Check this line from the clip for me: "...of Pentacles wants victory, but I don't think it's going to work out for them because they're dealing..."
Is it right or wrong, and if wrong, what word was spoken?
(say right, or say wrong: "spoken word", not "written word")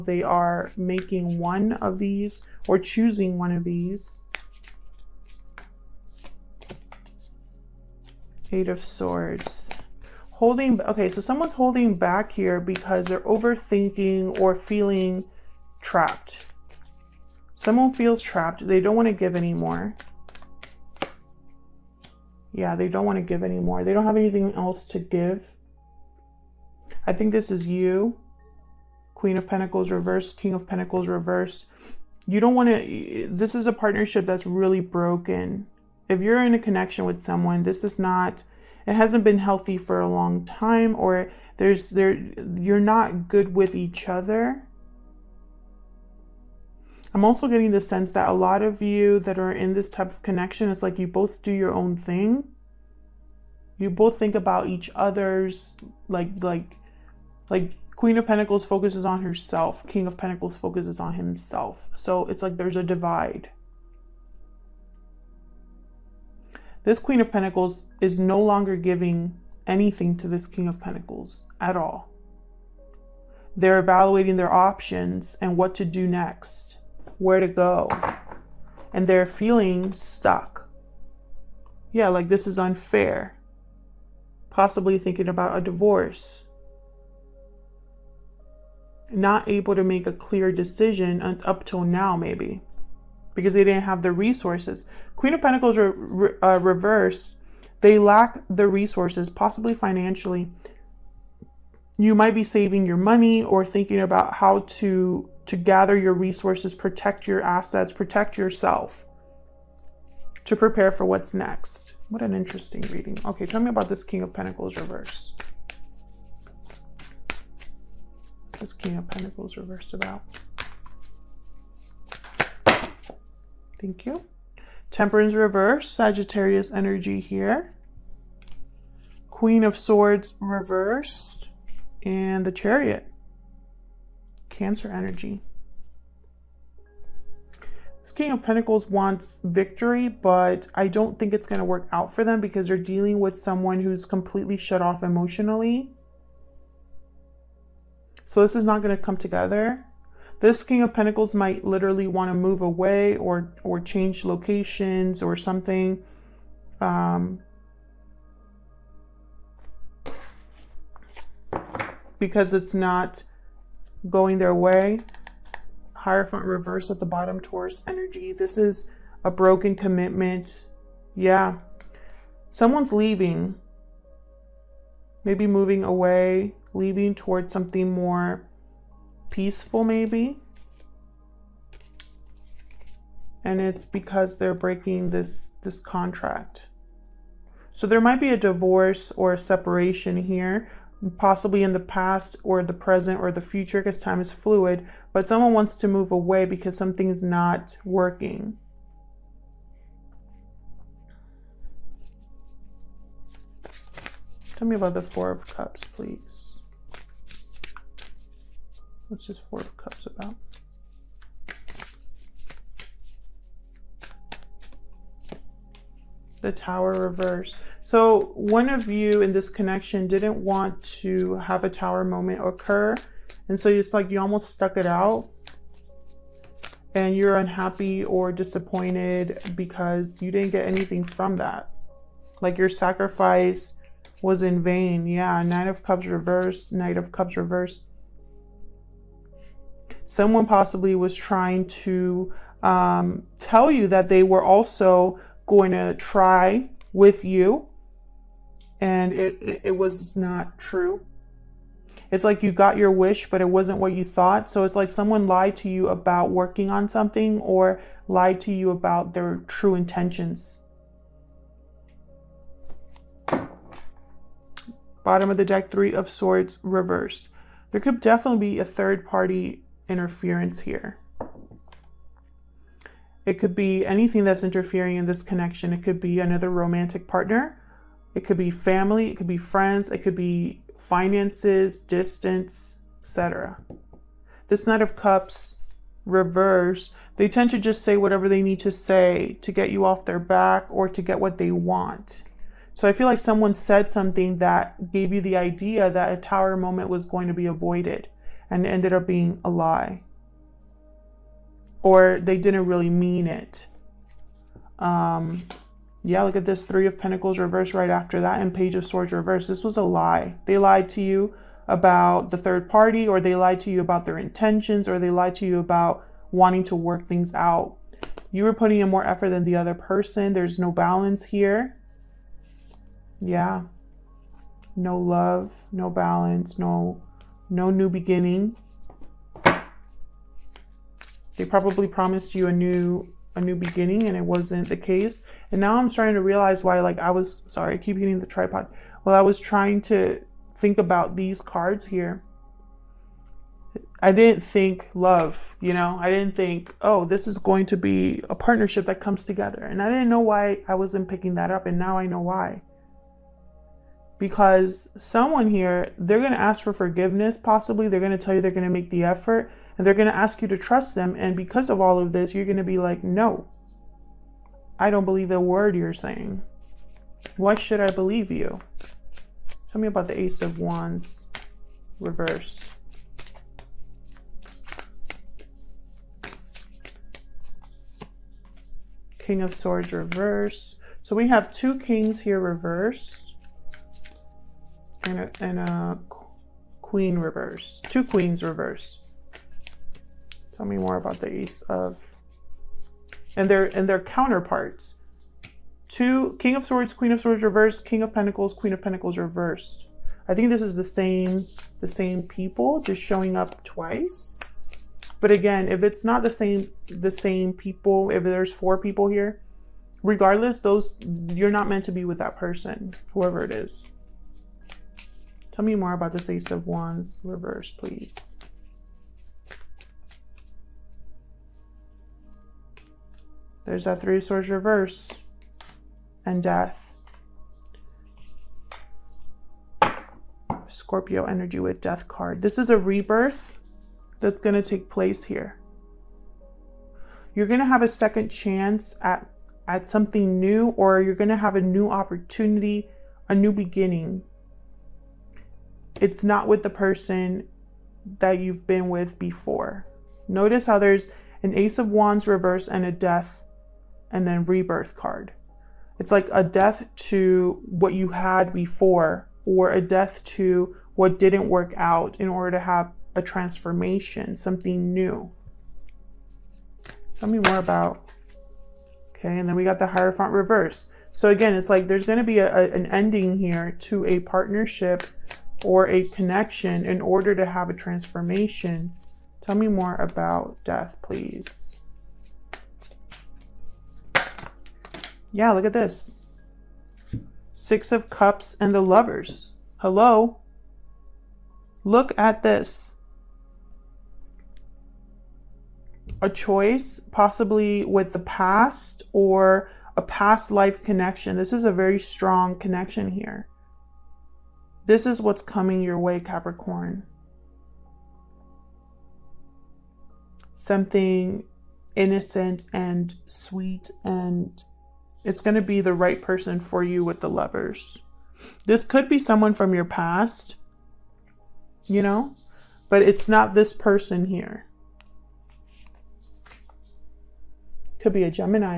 right.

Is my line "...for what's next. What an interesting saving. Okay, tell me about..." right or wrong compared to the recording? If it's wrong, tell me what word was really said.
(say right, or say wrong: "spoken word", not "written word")
wrong: "reading", not "saving".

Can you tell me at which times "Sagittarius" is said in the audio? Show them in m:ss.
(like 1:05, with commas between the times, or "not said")
2:05.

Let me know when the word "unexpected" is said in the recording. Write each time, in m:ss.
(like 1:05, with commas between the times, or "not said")
not said.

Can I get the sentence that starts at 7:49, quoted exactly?
Okay, and then we got the Hierophant reverse.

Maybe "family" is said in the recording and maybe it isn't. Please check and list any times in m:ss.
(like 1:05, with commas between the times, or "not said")
4:38.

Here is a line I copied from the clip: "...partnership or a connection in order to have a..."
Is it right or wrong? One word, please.
right.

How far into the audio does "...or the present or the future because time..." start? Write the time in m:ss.
3:12.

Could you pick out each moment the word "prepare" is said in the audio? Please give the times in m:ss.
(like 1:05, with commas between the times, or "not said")
1:50.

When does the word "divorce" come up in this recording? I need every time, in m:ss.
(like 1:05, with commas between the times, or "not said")
1:25, 3:08.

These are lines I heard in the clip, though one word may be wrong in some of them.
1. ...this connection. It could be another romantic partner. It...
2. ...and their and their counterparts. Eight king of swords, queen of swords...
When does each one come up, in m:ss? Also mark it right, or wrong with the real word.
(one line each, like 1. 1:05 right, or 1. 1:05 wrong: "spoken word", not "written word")
1. 4:35 right
2. 6:33 wrong: "Two", not "Eight".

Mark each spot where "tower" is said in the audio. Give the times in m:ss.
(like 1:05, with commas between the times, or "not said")
3:36, 3:41, 4:56.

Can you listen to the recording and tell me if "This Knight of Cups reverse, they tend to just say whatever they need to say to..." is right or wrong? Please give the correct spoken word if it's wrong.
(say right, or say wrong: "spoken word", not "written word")
right.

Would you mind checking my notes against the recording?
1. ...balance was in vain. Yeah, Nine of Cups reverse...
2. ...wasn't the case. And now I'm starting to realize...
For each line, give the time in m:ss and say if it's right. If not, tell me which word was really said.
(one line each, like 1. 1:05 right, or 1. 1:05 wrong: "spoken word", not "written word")
1. 3:52 wrong: "sacrifice", not "balance"
2. 5:34 right.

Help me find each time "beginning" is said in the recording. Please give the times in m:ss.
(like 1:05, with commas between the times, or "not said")
5:27, 5:33, 7:23.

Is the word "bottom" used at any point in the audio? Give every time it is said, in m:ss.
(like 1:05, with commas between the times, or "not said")
2:47, 4:25.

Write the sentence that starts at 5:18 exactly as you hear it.
You were putting in more effort than the other person.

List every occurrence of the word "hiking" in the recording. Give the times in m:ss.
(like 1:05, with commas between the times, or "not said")
not said.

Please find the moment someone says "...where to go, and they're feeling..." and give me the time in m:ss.
1:17.